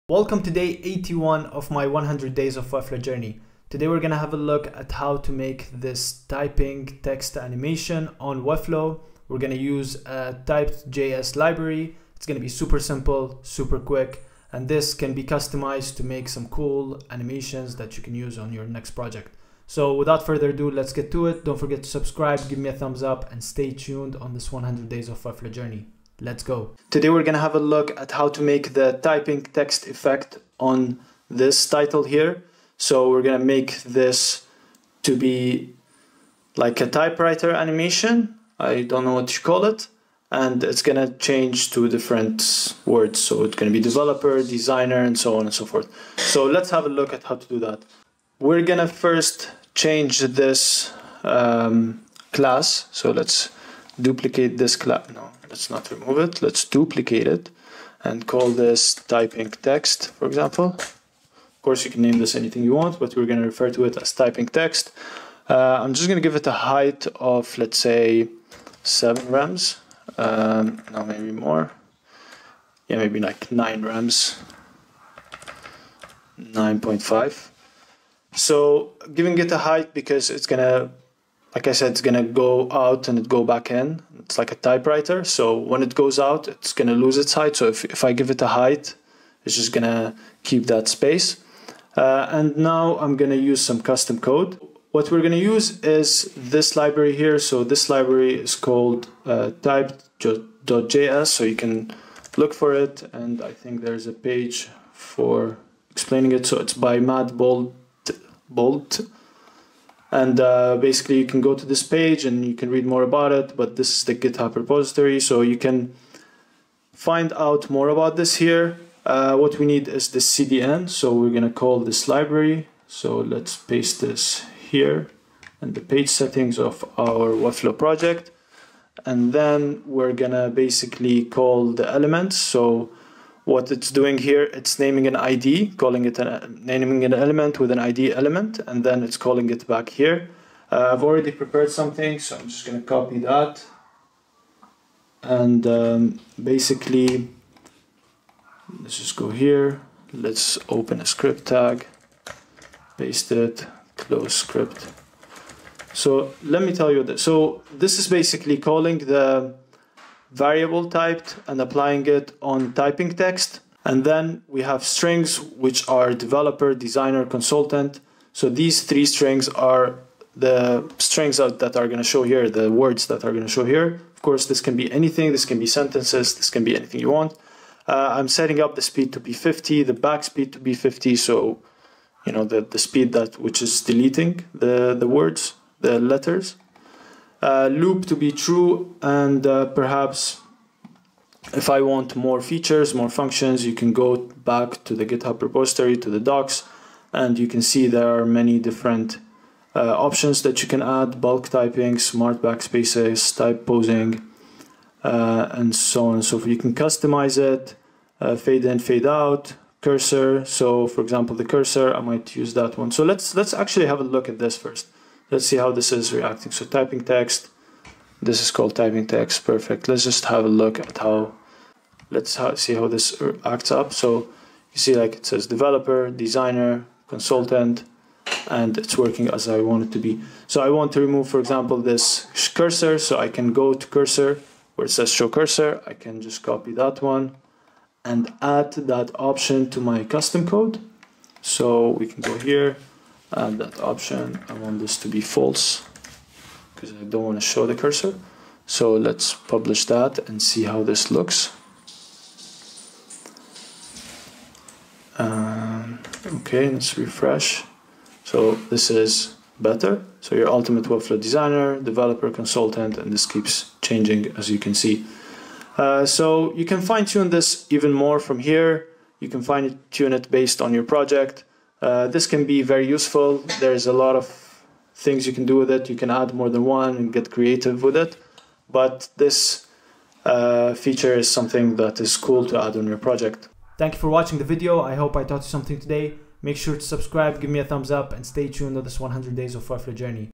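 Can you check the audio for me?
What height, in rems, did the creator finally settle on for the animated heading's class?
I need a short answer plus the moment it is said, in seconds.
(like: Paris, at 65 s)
9.5, at 76 s.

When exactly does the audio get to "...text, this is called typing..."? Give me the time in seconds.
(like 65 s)
217 s.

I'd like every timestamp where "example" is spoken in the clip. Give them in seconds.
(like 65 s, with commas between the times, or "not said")
60 s, 211 s, 231 s.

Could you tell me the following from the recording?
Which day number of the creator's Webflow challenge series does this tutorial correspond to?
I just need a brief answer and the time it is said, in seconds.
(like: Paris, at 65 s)
81, at 0 s.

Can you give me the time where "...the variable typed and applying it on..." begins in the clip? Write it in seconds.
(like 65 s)
158 s.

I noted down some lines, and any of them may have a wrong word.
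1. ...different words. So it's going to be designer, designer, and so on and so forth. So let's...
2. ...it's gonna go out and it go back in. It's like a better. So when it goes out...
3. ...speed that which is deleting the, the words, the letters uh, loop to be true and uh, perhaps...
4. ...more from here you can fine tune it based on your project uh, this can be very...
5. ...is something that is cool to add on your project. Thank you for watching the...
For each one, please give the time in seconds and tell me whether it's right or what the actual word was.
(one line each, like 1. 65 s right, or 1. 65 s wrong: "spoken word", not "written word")
1. 41 s wrong: "developer", not "designer"
2. 81 s wrong: "typewriter", not "better"
3. 182 s right
4. 267 s right
5. 281 s right.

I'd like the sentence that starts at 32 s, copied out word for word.
So we're going to make this to be like a typewriter animation.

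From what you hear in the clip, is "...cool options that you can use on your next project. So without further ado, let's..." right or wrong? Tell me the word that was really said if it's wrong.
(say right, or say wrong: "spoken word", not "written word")
wrong: "animations", not "options".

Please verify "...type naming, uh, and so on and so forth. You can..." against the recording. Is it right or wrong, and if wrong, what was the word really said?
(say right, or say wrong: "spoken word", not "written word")
wrong: "pausing", not "naming".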